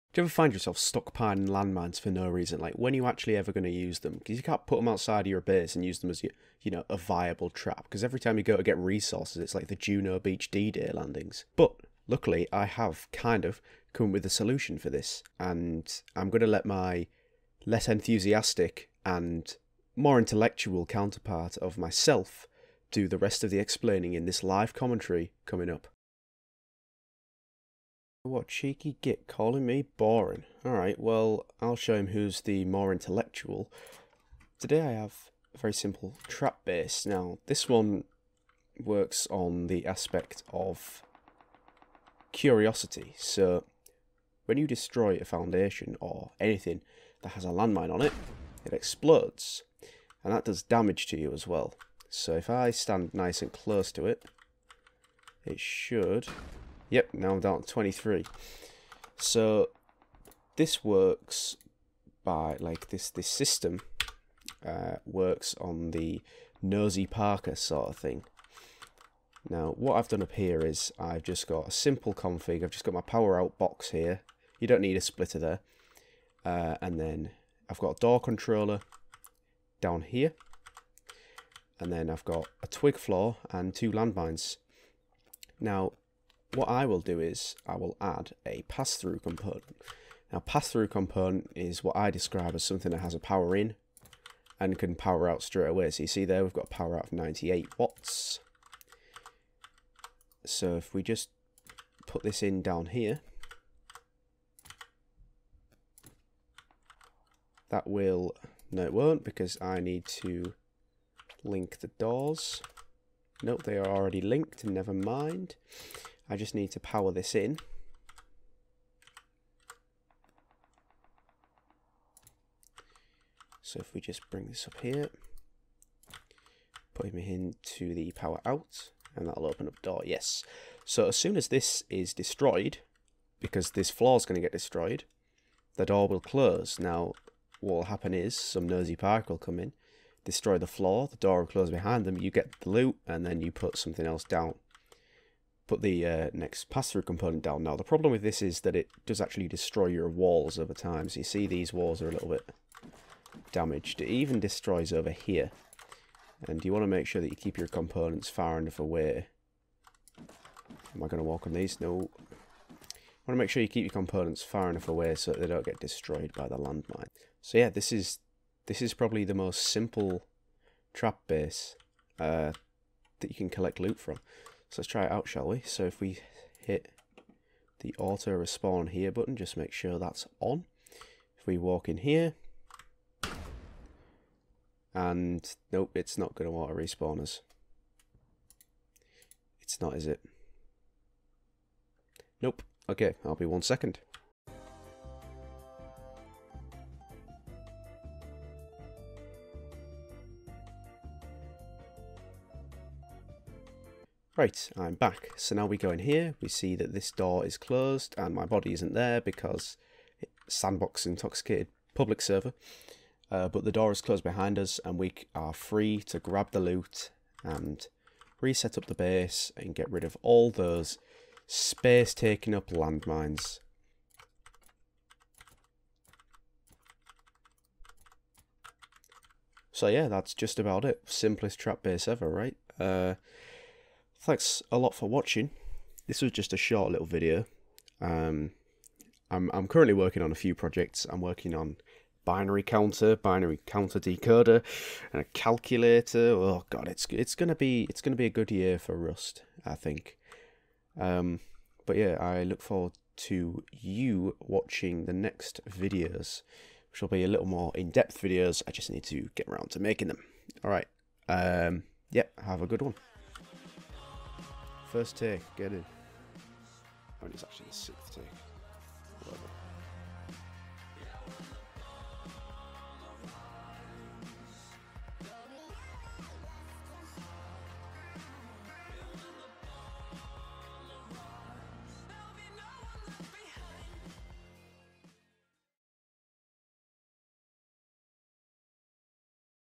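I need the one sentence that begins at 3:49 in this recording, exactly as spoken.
So yeah, that's just about it.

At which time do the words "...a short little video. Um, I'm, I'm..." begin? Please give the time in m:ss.
3:56.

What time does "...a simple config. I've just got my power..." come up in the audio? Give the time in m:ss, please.
1:11.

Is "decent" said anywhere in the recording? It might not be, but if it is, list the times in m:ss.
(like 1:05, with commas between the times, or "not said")
not said.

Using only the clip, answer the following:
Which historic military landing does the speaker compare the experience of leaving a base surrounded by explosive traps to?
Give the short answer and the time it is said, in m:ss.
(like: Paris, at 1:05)
Juno Beach D-Day landings, at 0:09.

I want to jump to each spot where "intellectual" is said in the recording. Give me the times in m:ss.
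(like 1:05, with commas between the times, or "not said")
0:20, 0:32.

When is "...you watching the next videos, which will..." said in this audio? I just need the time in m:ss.
4:13.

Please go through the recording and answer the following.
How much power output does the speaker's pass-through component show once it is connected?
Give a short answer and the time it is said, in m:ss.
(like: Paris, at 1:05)
98 watts, at 1:37.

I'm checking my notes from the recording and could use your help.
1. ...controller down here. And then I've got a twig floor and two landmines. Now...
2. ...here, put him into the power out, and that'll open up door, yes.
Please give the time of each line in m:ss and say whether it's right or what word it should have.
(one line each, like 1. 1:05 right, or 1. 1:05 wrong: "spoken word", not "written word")
1. 1:18 right
2. 2:04 right.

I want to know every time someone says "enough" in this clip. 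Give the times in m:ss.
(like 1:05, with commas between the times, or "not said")
2:38, 2:44.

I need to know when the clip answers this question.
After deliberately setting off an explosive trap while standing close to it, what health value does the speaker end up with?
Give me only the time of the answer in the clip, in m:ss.
0:57.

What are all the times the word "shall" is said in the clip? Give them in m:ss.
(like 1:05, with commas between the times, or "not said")
2:55.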